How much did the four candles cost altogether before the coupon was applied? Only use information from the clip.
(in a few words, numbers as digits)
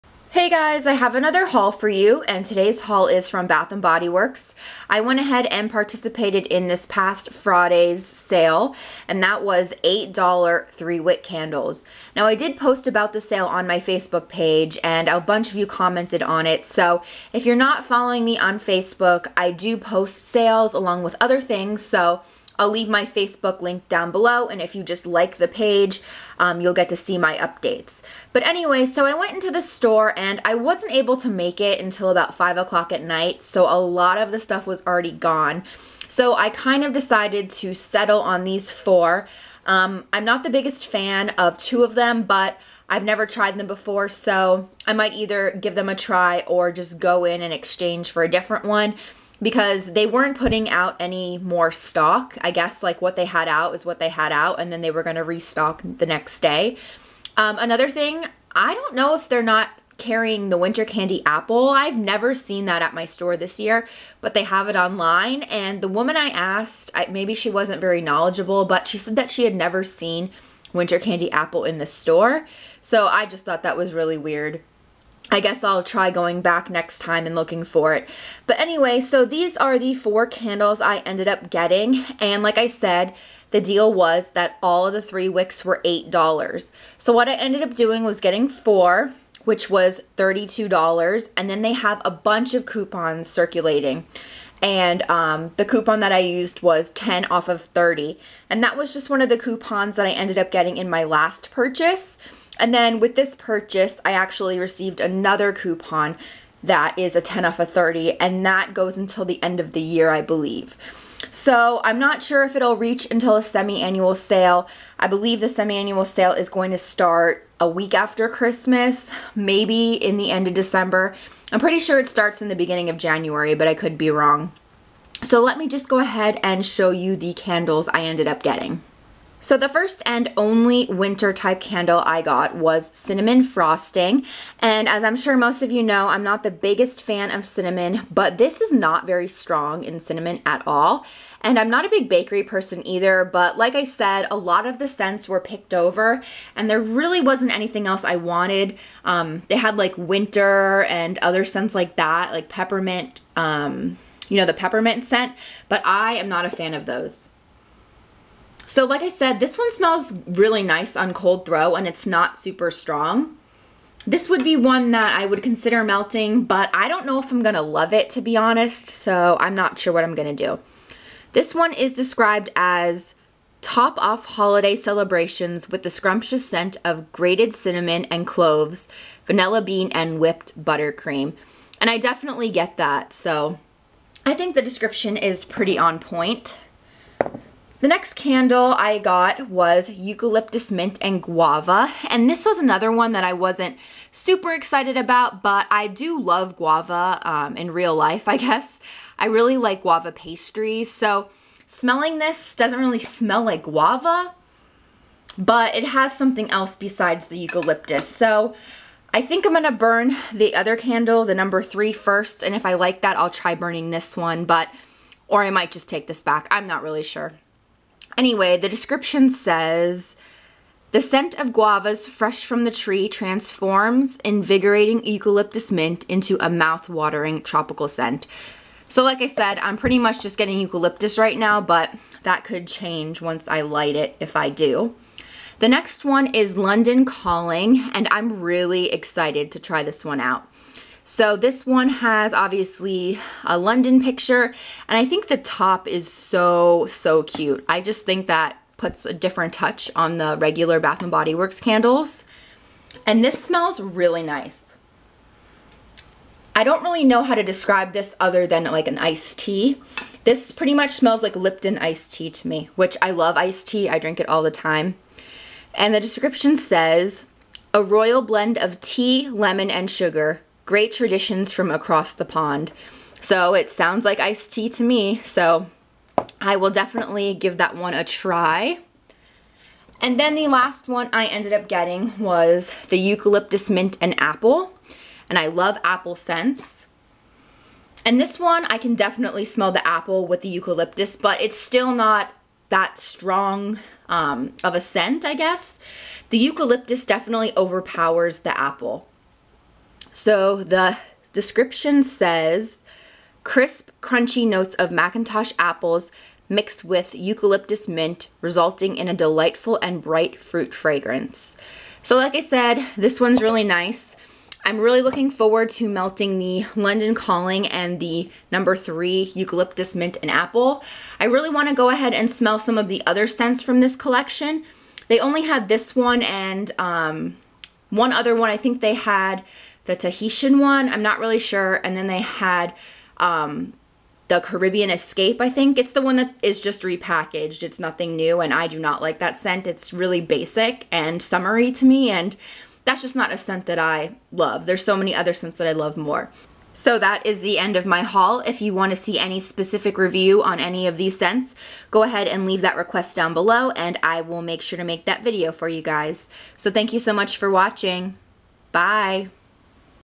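$32.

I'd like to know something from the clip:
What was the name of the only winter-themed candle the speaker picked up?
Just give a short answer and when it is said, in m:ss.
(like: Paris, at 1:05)
Cinnamon frosting, at 2:12.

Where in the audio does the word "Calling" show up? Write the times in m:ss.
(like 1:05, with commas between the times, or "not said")
3:57, 5:17.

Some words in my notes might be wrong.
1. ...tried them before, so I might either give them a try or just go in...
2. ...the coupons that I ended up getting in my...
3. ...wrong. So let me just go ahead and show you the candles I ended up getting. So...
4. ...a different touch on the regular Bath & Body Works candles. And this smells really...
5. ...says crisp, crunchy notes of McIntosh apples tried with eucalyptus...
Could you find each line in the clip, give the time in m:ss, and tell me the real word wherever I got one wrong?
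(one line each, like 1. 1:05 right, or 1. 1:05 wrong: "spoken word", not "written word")
1. 0:43 right
2. 1:39 right
3. 2:04 right
4. 4:09 right
5. 5:02 wrong: "mixed", not "tried".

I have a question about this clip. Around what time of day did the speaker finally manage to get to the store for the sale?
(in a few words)
5 o'clock.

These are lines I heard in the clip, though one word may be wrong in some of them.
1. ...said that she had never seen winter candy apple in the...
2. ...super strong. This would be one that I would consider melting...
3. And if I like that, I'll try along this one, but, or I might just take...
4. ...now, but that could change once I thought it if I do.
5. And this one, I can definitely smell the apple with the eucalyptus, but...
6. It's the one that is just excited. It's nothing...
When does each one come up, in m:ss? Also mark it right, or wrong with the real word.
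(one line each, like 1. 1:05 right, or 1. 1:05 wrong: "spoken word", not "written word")
1. 1:08 right
2. 2:42 right
3. 3:32 wrong: "burning", not "along"
4. 3:51 wrong: "light", not "thought"
5. 4:48 right
6. 5:35 wrong: "repackaged", not "excited".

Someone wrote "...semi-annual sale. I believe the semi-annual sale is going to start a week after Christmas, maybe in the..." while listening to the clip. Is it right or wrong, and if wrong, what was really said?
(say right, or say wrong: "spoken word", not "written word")
right.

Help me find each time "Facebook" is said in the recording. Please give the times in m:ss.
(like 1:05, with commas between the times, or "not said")
0:13, 0:18, 0:23.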